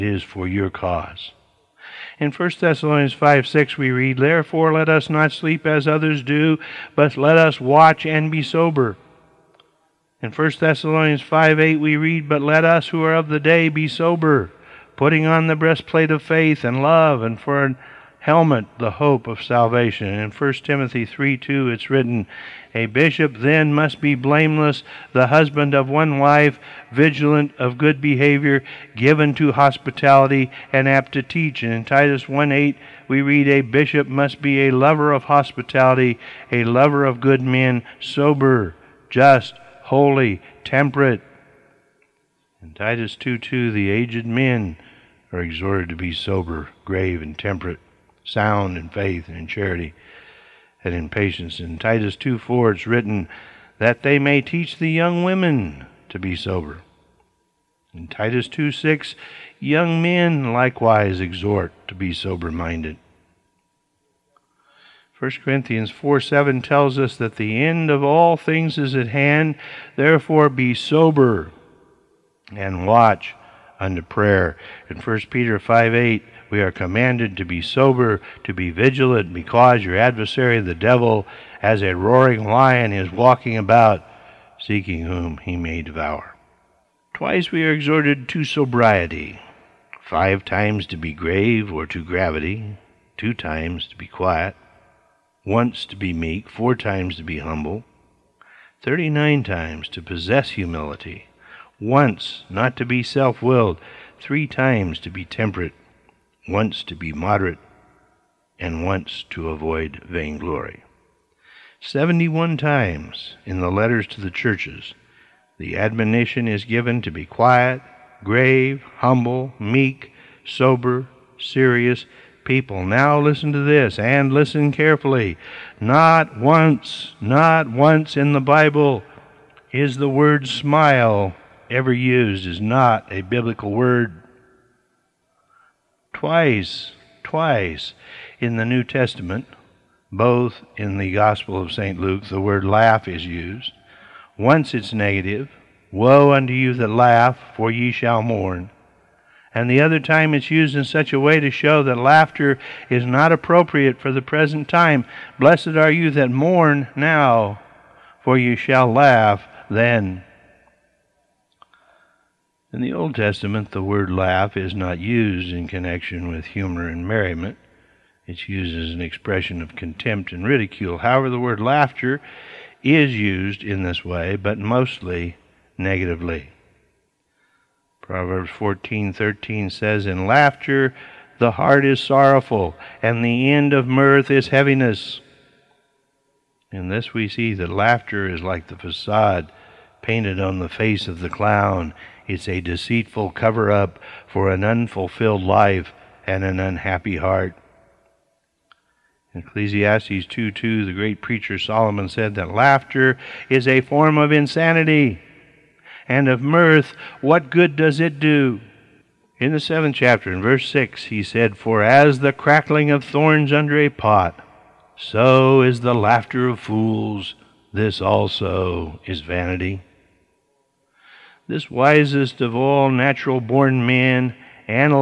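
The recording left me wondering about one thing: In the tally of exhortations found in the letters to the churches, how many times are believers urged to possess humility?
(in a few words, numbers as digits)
39.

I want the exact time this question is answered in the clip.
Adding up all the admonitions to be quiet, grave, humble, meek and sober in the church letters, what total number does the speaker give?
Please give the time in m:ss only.
1:51.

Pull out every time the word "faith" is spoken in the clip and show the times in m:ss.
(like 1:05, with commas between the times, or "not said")
0:16, 0:48.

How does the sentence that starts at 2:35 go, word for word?
Blessed are you that mourn now, for you shall laugh then.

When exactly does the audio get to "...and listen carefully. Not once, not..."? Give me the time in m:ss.
2:03.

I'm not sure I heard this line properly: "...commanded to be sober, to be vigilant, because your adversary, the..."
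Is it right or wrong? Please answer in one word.
right.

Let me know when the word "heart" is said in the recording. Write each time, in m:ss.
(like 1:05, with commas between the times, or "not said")
3:01, 3:17.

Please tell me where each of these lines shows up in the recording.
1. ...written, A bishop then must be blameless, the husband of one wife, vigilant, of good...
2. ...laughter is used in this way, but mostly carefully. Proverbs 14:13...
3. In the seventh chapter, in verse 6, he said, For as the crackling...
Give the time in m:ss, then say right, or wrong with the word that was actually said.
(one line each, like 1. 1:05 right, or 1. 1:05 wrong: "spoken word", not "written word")
1. 0:21 right
2. 2:51 wrong: "negatively", not "carefully"
3. 3:29 right.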